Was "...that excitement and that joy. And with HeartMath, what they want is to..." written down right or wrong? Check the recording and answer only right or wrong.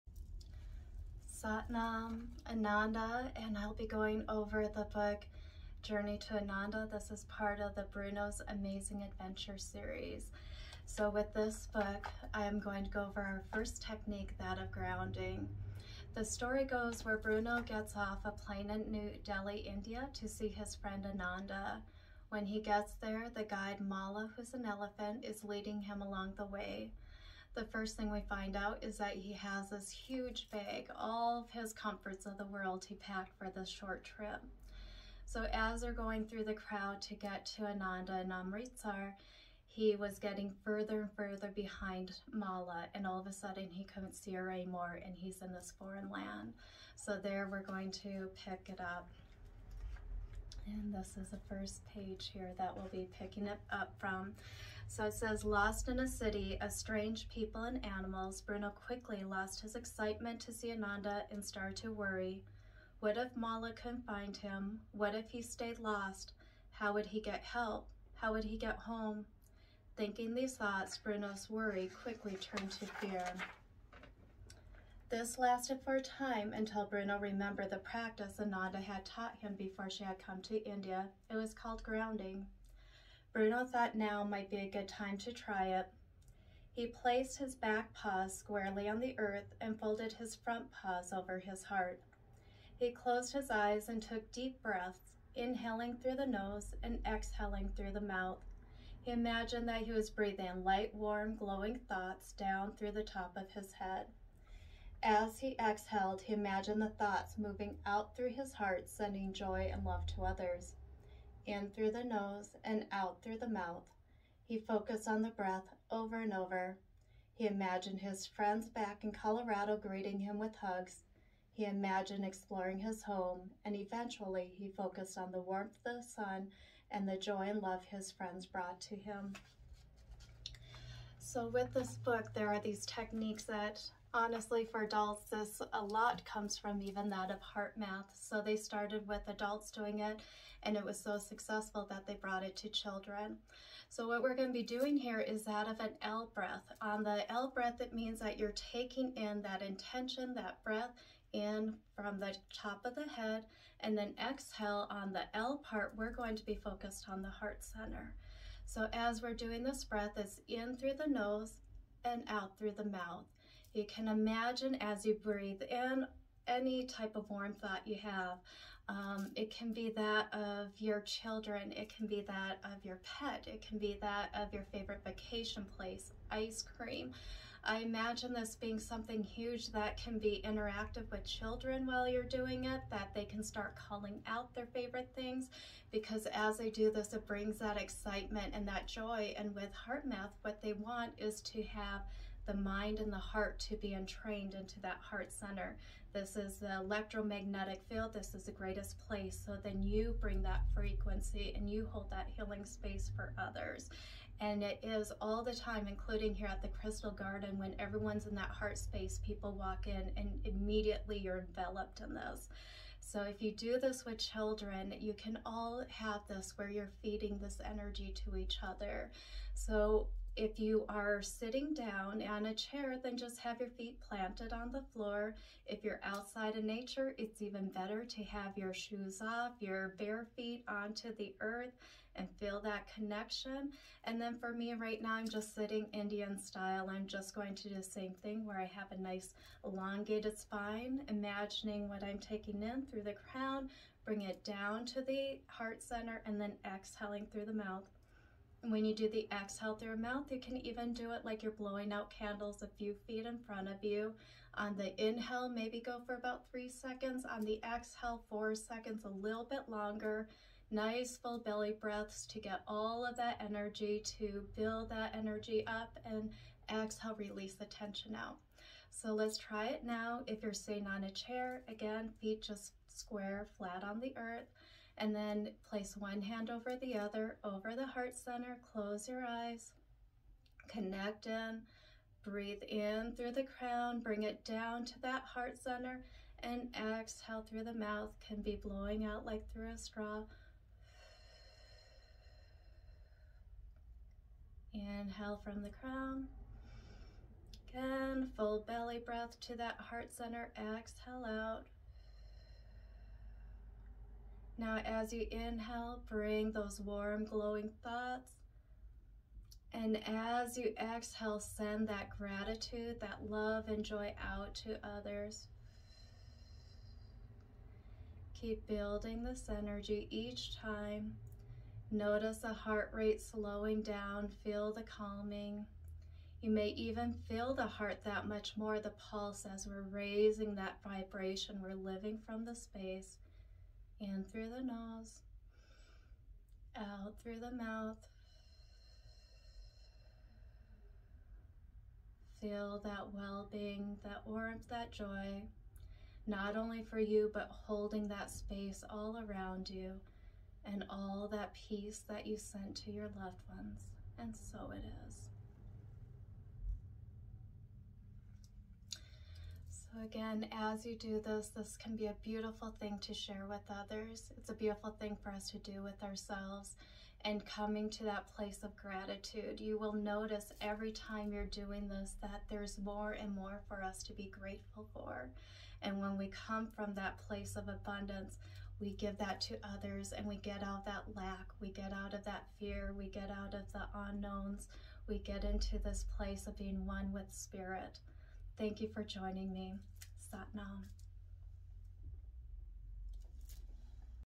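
right.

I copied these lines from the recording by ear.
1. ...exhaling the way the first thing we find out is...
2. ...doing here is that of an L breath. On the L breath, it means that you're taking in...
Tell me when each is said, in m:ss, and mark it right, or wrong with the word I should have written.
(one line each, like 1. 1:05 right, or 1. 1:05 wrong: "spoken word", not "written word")
1. 0:26 wrong: "along", not "exhaling"
2. 2:24 right.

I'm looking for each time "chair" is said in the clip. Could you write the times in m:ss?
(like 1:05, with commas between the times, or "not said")
3:42, 4:31.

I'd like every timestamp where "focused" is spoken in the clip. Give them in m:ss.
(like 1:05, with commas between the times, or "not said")
1:54, 2:04, 2:36.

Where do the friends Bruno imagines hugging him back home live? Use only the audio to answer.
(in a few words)
Colorado.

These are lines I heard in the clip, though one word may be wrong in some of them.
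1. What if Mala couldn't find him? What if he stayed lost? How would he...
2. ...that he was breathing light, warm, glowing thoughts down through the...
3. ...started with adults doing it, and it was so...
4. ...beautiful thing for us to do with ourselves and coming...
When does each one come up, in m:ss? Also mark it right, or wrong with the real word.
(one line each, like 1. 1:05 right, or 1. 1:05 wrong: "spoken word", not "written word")
1. 1:02 right
2. 1:39 right
3. 2:18 right
4. 6:04 right.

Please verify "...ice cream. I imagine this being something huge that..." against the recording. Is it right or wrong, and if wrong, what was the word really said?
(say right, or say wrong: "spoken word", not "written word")
right.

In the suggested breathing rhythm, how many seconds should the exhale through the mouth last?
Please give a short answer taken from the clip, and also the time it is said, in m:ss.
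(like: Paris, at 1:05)
4, at 4:18.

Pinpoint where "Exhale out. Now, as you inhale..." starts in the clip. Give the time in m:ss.
5:00.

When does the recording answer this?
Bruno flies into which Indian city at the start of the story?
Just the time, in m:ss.
0:18.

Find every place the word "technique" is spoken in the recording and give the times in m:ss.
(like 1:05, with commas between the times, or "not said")
0:13, 2:12.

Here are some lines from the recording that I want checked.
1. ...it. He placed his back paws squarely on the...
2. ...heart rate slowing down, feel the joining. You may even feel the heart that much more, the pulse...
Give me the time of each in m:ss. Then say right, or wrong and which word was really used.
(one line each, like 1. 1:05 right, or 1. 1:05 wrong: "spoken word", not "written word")
1. 1:25 right
2. 5:22 wrong: "calming", not "joining".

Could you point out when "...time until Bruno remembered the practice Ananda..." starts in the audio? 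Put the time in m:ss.
1:16.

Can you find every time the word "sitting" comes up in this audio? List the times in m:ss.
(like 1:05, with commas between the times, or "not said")
3:41, 3:55, 4:30.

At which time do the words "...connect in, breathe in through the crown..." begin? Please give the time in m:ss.
4:40.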